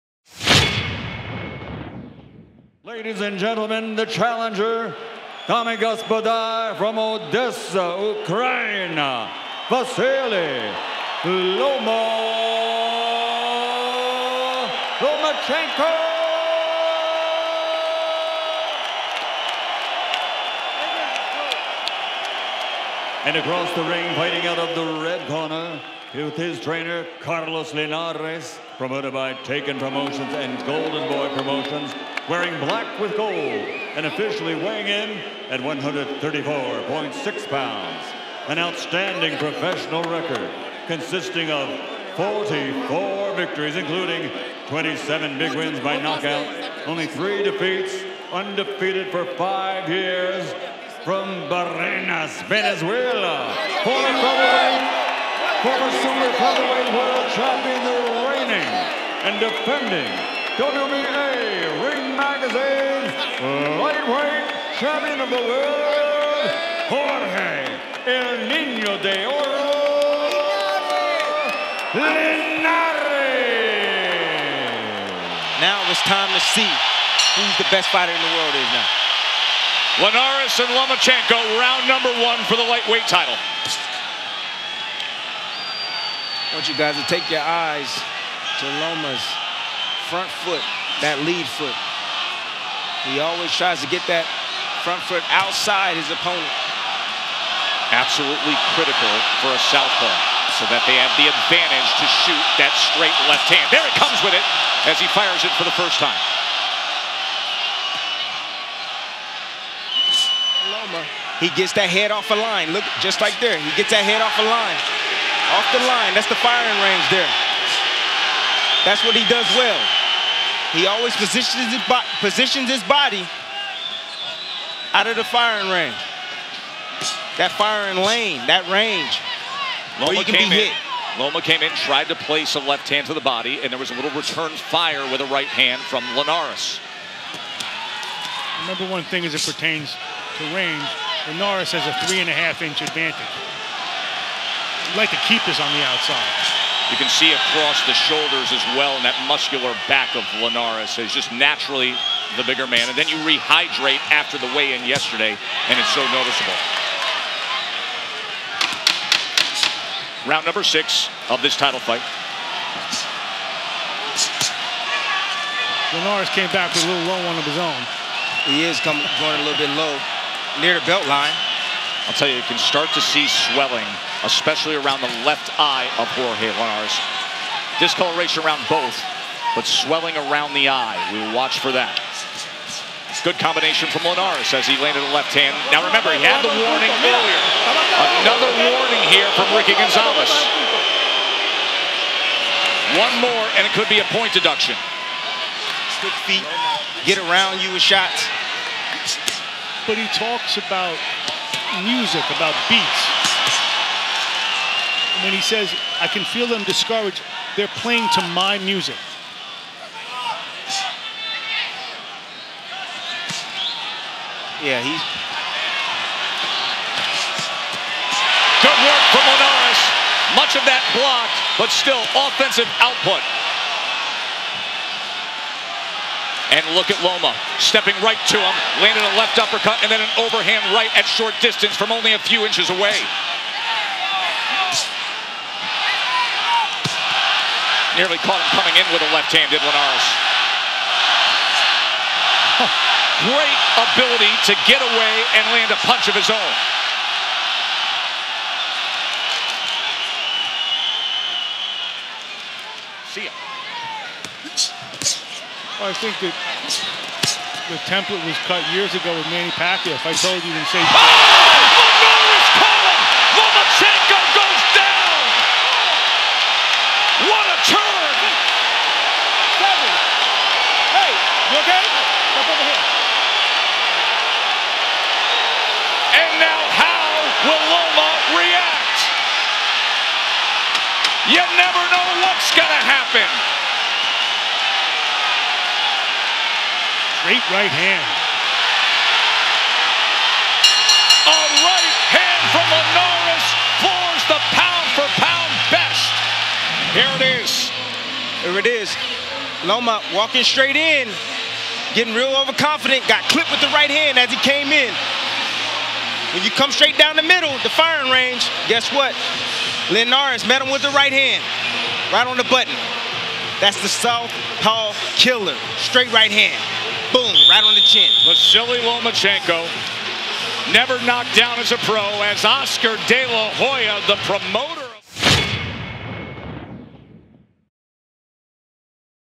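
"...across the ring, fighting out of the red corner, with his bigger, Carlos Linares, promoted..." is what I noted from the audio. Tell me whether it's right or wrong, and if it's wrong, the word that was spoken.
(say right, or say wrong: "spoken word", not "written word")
wrong: "trainer", not "bigger".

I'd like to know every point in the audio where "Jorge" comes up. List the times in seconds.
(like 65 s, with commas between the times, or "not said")
66 s, 176 s.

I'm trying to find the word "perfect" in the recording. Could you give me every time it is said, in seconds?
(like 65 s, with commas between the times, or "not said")
not said.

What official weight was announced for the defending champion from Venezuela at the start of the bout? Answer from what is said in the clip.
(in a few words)
134.6 pounds.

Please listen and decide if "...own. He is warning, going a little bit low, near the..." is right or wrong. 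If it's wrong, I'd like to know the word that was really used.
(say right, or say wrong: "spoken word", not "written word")
wrong: "coming", not "warning".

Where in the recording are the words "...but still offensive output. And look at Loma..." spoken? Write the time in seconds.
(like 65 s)
221 s.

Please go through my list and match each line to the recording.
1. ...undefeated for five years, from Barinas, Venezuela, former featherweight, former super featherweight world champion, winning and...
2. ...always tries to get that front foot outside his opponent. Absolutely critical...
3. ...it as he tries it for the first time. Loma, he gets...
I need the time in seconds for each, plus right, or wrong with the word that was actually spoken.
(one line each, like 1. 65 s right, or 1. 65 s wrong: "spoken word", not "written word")
1. 48 s right
2. 93 s right
3. 104 s wrong: "fires", not "tries".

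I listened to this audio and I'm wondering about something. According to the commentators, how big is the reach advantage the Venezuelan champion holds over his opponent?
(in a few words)
three and a half inch.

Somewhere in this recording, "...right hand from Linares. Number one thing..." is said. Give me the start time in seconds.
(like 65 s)
135 s.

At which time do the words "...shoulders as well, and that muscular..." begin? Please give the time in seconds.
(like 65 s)
147 s.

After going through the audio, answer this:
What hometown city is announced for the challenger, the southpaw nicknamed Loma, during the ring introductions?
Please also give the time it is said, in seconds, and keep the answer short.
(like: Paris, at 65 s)
Odessa, at 6 s.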